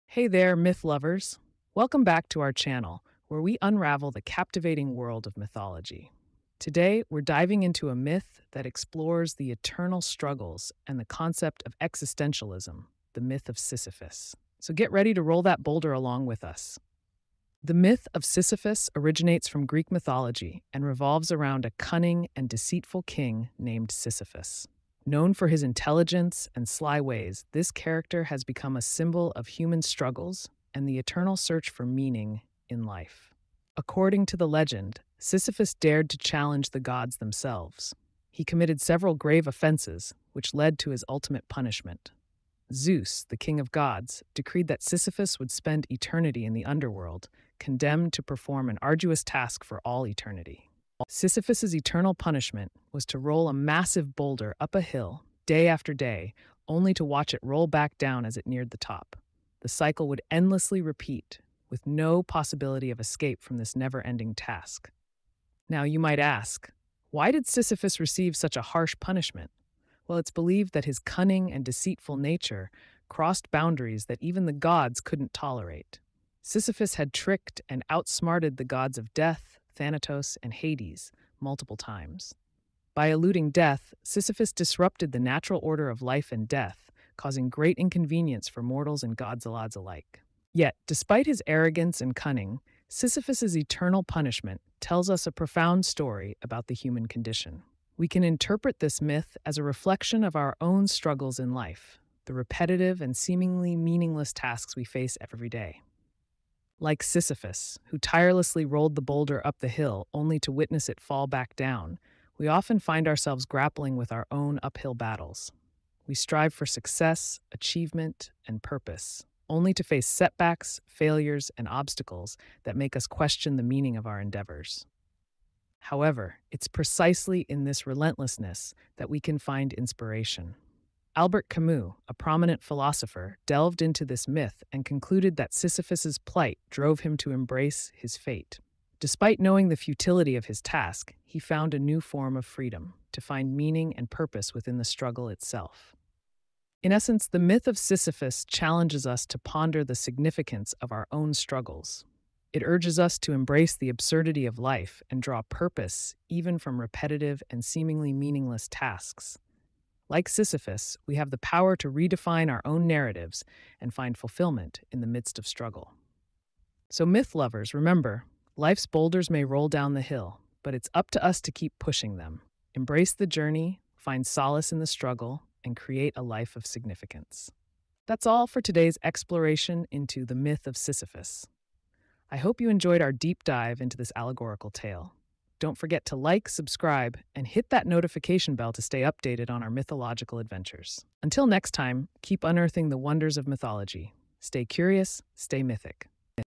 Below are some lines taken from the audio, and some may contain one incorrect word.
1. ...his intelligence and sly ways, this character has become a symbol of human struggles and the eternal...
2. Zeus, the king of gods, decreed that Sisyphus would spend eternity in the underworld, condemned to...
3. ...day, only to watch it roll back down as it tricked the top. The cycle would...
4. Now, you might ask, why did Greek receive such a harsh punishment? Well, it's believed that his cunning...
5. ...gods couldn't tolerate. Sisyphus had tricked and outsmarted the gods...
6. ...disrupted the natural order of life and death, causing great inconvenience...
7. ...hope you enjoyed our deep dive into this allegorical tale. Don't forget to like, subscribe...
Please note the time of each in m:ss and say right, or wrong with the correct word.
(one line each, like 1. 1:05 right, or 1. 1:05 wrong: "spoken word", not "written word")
1. 0:25 right
2. 0:42 right
3. 0:55 wrong: "neared", not "tricked"
4. 1:05 wrong: "Sisyphus", not "Greek"
5. 1:14 right
6. 1:24 right
7. 3:02 right.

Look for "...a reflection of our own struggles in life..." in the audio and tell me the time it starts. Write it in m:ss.
1:39.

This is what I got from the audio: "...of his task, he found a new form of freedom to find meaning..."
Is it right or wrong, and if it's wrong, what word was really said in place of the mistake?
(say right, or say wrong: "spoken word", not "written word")
right.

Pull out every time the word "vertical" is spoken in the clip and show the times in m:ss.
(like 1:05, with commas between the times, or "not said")
not said.